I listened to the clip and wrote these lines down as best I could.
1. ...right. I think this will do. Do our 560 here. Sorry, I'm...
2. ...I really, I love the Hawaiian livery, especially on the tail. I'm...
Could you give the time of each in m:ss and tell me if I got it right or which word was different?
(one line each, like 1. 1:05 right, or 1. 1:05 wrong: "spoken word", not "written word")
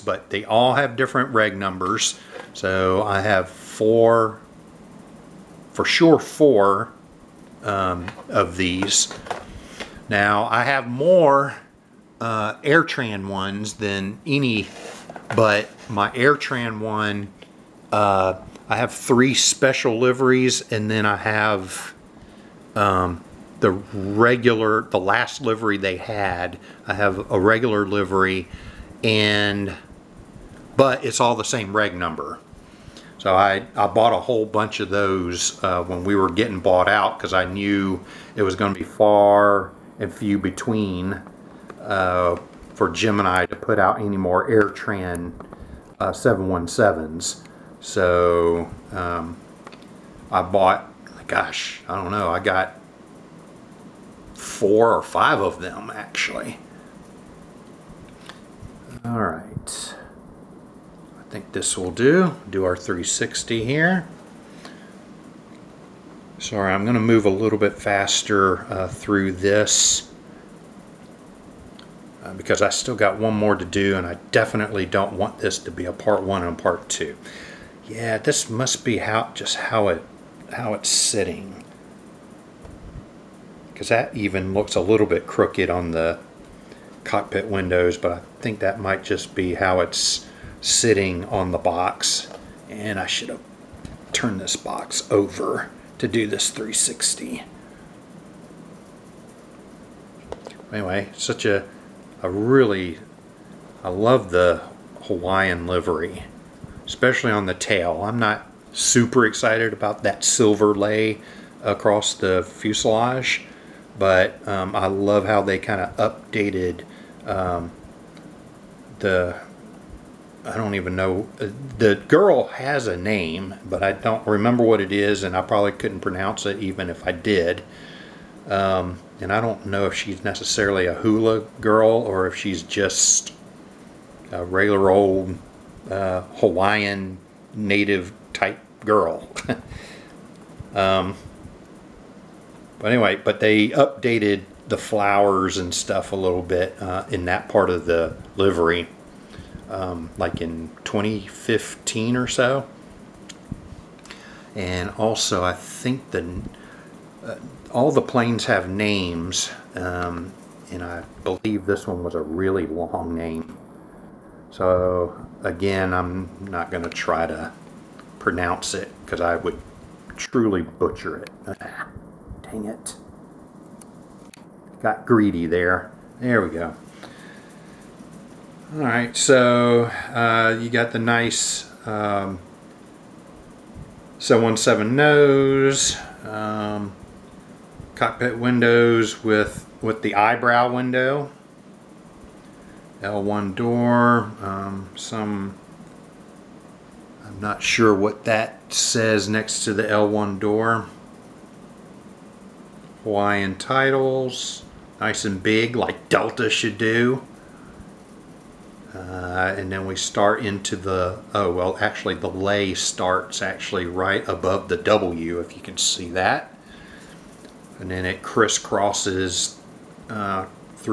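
1. 0:59 wrong: "360", not "560"
2. 1:42 right.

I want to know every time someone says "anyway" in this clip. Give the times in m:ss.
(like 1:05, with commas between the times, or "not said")
1:40, 2:22.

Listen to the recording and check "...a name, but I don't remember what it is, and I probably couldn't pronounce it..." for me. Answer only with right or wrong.
right.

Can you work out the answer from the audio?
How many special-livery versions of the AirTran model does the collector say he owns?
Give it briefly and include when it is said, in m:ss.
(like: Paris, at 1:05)
3, at 0:18.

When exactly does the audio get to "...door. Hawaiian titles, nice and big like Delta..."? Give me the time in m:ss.
3:20.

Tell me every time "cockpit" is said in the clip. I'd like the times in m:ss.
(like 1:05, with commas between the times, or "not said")
1:27, 3:07.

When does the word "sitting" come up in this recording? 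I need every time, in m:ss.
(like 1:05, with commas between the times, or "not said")
1:20, 1:30.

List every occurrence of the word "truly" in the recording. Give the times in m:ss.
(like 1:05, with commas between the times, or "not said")
2:50.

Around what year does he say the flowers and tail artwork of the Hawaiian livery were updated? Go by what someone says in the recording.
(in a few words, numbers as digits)
2015.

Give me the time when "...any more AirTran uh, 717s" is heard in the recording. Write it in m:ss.
0:44.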